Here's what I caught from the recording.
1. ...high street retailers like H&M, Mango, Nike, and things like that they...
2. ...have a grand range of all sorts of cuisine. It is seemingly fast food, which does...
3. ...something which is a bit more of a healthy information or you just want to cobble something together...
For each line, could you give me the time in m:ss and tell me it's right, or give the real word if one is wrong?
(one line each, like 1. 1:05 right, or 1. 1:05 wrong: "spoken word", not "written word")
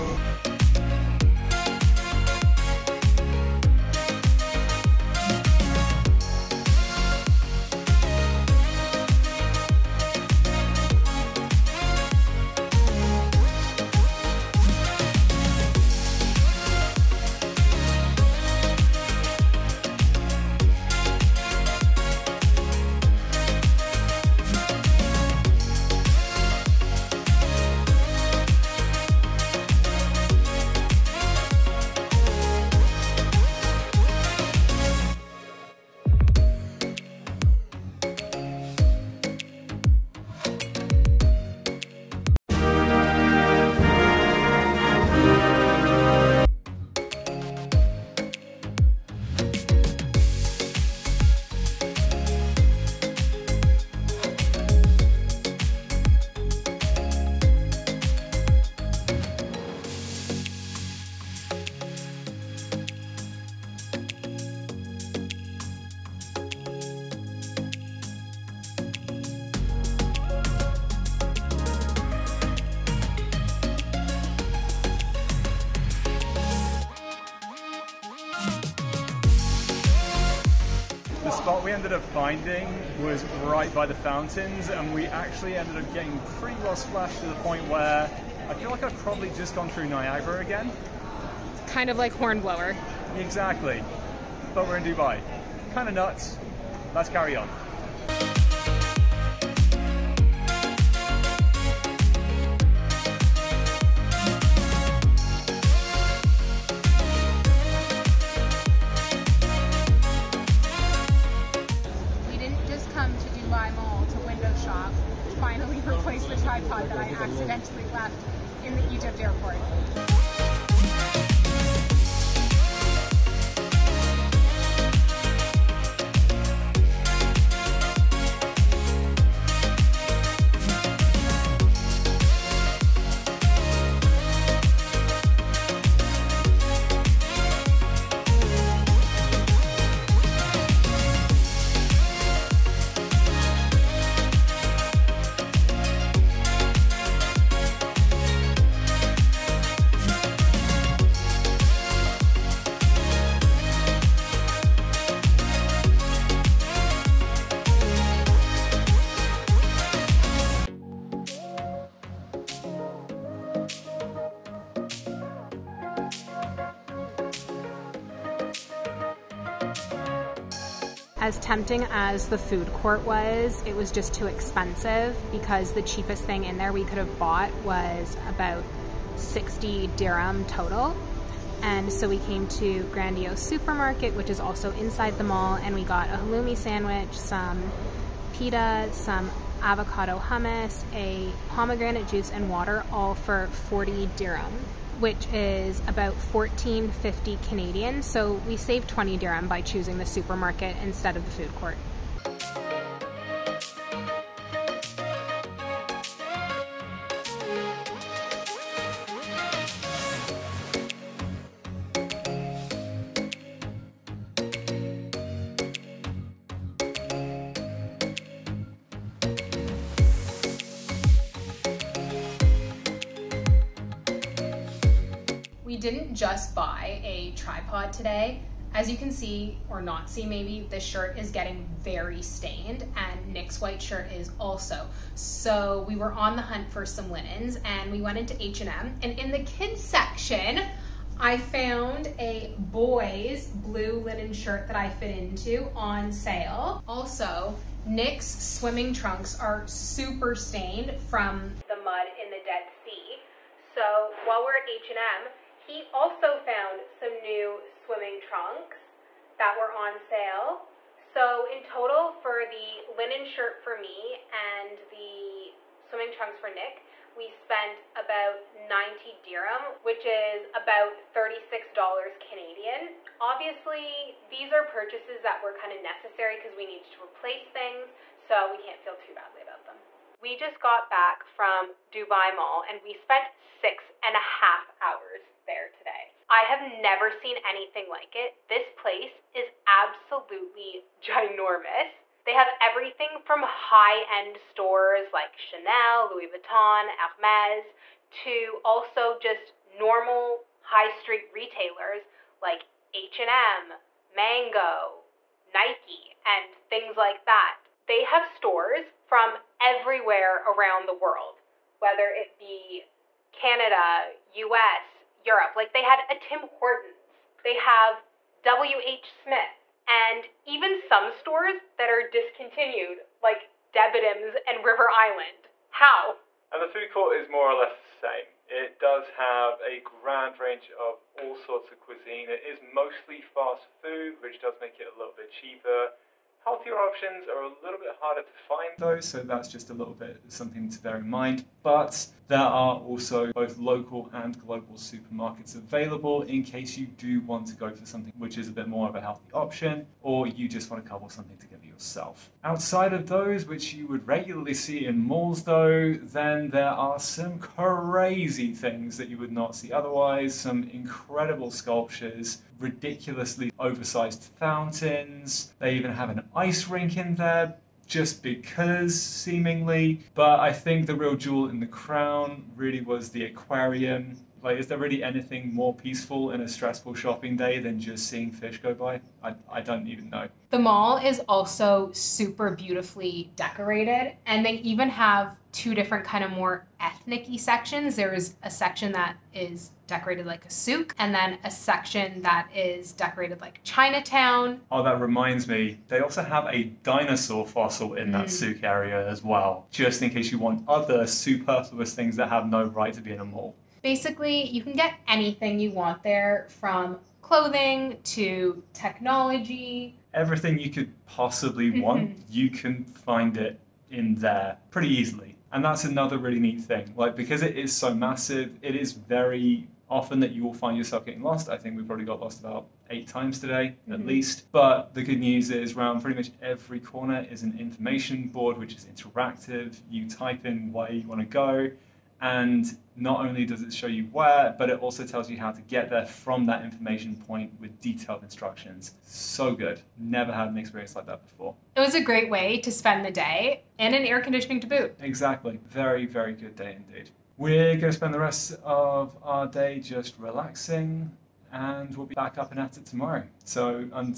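1. 5:00 right
2. 5:29 wrong: "mostly", not "seemingly"
3. 5:47 wrong: "option", not "information".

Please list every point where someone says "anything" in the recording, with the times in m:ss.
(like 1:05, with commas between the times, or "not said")
4:47, 6:15, 6:45.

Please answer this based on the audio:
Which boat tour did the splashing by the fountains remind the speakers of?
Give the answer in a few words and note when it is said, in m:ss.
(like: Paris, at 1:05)
Hornblower, at 1:32.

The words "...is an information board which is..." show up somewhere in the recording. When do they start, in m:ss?
7:07.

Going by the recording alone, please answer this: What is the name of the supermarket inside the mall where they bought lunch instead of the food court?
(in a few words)
Grandio Supermarket.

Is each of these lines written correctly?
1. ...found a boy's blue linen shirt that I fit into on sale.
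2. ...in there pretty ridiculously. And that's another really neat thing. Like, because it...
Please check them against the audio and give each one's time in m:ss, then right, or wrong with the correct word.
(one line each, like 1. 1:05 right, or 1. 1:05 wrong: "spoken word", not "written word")
1. 4:01 right
2. 6:53 wrong: "easily", not "ridiculously".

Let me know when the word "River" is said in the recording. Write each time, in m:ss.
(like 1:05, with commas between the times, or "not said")
5:24.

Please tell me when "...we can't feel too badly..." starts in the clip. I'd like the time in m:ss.
4:38.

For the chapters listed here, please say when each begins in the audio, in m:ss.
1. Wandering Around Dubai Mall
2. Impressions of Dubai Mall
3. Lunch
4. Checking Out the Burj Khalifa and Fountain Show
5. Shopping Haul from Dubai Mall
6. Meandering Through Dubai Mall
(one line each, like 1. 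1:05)
1. 1:37
2. 4:40
3. 2:50
4. 0:48
5. 3:45
6. 3:22.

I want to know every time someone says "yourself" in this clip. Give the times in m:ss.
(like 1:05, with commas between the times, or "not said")
5:51, 7:00.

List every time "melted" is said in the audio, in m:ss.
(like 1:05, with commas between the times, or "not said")
not said.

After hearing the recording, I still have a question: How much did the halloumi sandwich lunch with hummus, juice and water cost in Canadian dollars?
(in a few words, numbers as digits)
$14.50.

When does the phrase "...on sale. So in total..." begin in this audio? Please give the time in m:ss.
4:19.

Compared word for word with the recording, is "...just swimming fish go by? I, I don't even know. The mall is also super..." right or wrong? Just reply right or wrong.
wrong.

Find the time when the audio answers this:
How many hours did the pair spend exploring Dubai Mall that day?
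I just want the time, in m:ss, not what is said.
4:43.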